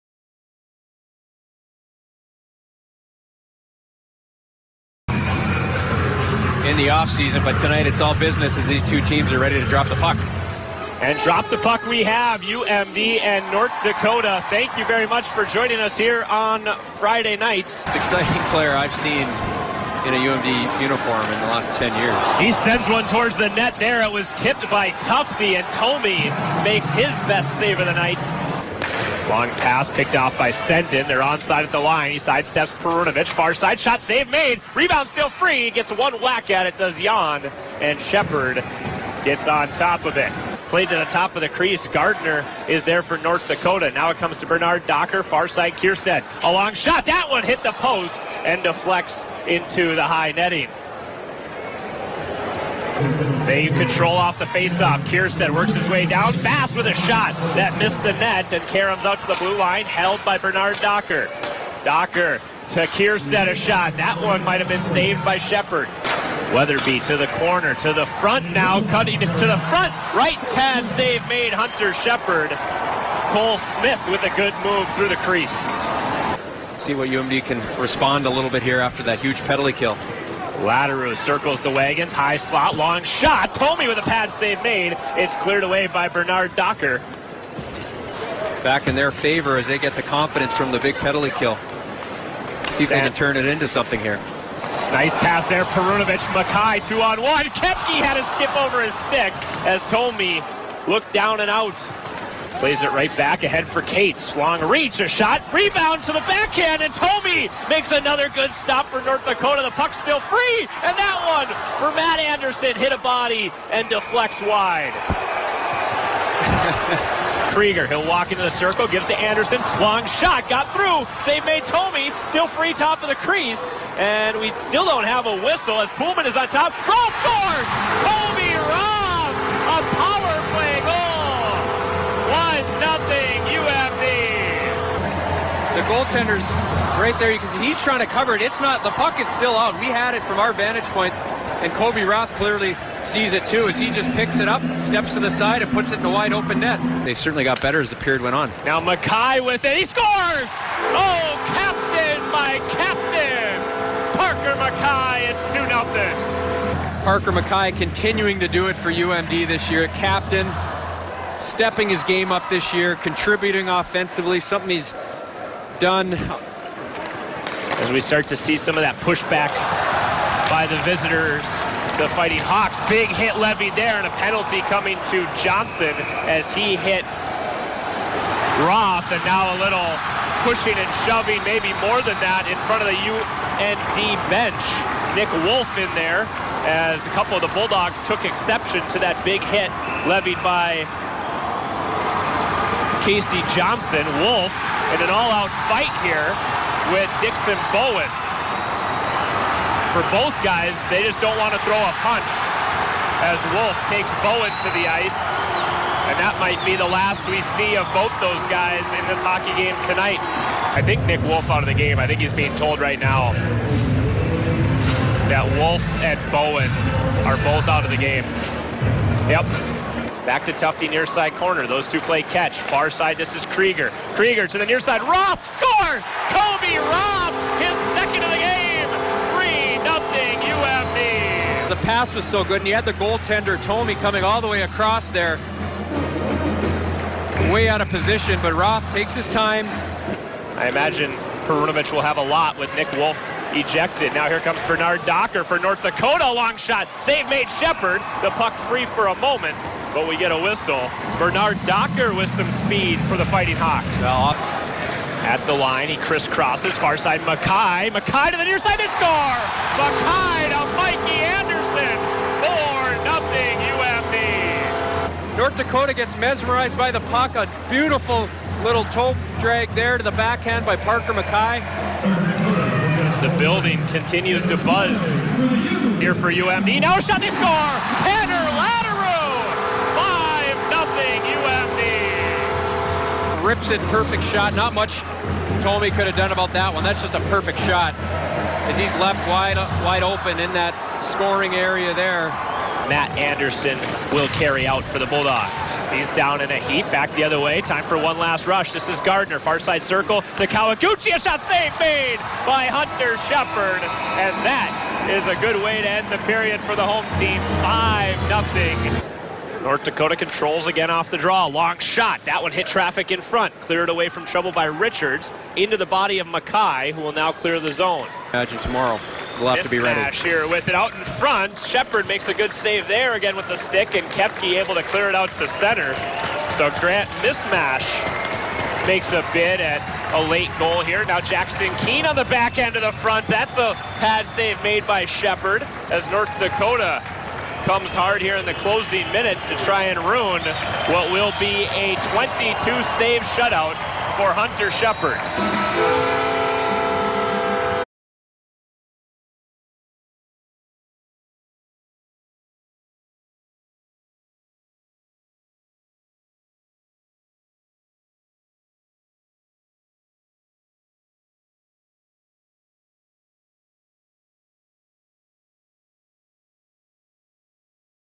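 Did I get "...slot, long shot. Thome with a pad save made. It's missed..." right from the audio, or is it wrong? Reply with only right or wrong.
wrong.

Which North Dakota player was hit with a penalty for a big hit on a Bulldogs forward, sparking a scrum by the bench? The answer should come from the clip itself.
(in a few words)
Casey Johnson.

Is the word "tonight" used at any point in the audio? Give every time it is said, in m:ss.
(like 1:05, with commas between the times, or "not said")
0:07, 3:29.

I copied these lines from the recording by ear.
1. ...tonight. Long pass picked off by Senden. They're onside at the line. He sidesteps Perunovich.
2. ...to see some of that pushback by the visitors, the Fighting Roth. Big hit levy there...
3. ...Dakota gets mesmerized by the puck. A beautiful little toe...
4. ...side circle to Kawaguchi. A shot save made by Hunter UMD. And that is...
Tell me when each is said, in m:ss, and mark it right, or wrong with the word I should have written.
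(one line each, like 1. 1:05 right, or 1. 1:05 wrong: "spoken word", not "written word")
1. 0:27 wrong: "night", not "tonight"
2. 2:48 wrong: "Hawks", not "Roth"
3. 4:25 right
4. 4:59 wrong: "Shepard", not "UMD".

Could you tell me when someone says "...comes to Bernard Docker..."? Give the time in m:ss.
0:44.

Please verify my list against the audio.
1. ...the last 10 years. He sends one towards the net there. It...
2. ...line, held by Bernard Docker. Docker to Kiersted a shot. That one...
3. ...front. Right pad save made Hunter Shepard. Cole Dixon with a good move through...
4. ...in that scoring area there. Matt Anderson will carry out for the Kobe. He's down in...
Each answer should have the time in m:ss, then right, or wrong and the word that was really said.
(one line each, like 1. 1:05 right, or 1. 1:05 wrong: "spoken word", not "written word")
1. 0:21 right
2. 0:59 right
3. 1:09 wrong: "Smith", not "Dixon"
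4. 4:50 wrong: "Bulldogs", not "Kobe".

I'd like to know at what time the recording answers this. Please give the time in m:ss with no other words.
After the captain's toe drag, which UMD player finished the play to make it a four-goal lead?
4:20.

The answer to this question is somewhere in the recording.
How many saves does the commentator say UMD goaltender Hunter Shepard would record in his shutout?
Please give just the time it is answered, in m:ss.
5:42.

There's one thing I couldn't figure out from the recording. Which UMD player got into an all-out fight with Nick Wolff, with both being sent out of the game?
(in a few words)
Dixon Bowen.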